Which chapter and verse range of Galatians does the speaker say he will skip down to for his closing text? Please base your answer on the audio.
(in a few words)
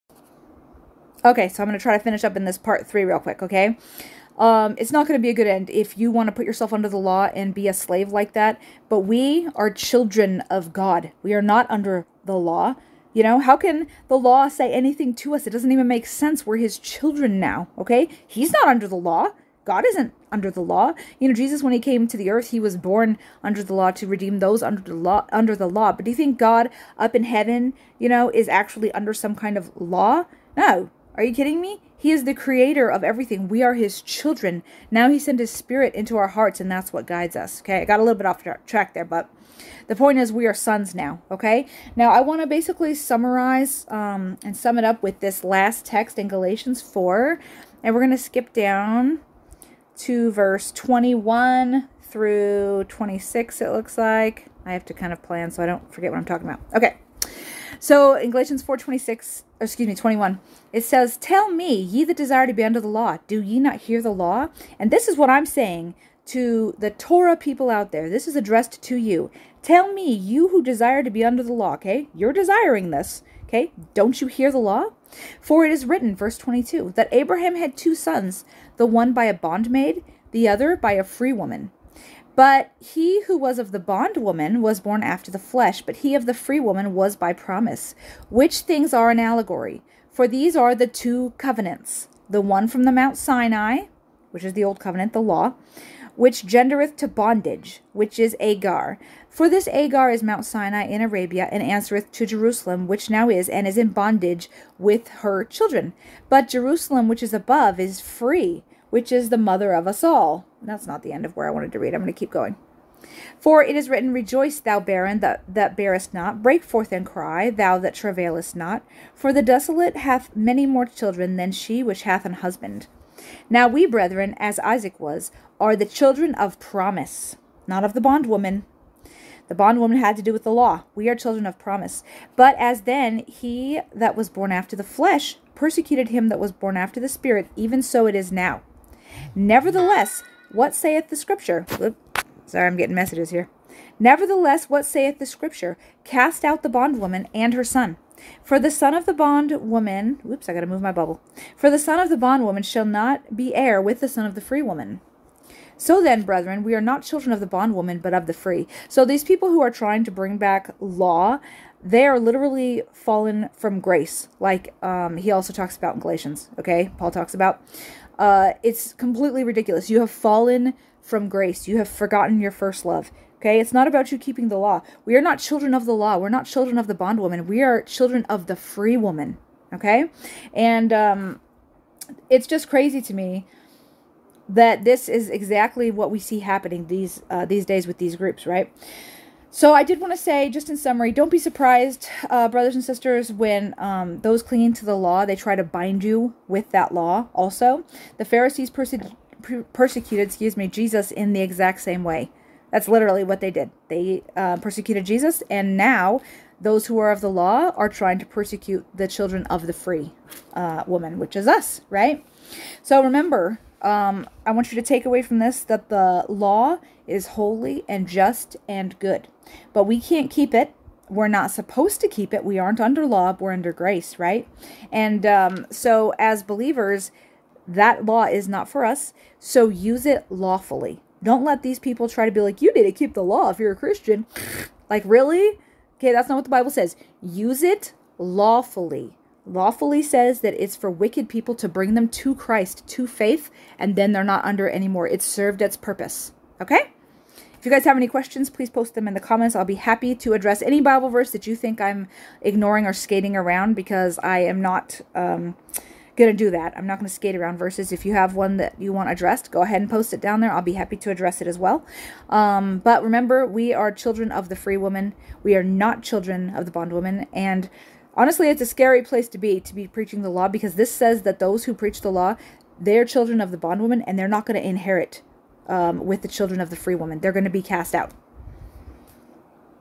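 Verses 21 through 26.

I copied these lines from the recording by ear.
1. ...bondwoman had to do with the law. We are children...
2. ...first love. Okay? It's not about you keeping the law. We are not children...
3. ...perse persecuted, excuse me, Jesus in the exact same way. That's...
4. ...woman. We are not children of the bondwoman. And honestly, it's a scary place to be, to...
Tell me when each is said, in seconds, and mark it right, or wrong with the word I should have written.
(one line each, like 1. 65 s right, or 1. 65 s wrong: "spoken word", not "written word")
1. 129 s right
2. 172 s right
3. 198 s right
4. 264 s right.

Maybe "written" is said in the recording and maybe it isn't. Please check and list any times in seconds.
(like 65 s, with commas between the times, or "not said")
75 s, 113 s.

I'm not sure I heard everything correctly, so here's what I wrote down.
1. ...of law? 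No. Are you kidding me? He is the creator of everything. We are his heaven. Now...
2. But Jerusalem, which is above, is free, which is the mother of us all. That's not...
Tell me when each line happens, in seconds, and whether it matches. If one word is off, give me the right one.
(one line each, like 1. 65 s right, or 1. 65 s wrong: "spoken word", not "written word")
1. 29 s wrong: "children", not "heaven"
2. 106 s right.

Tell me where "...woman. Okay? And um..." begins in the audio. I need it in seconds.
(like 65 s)
178 s.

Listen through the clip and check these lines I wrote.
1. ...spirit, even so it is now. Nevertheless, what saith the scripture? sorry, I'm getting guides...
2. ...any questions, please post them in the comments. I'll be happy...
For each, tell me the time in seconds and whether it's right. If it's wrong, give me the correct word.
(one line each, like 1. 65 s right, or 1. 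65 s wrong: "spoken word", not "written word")
1. 137 s wrong: "messages", not "guides"
2. 247 s right.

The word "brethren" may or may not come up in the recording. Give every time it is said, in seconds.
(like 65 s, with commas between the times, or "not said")
123 s, 156 s.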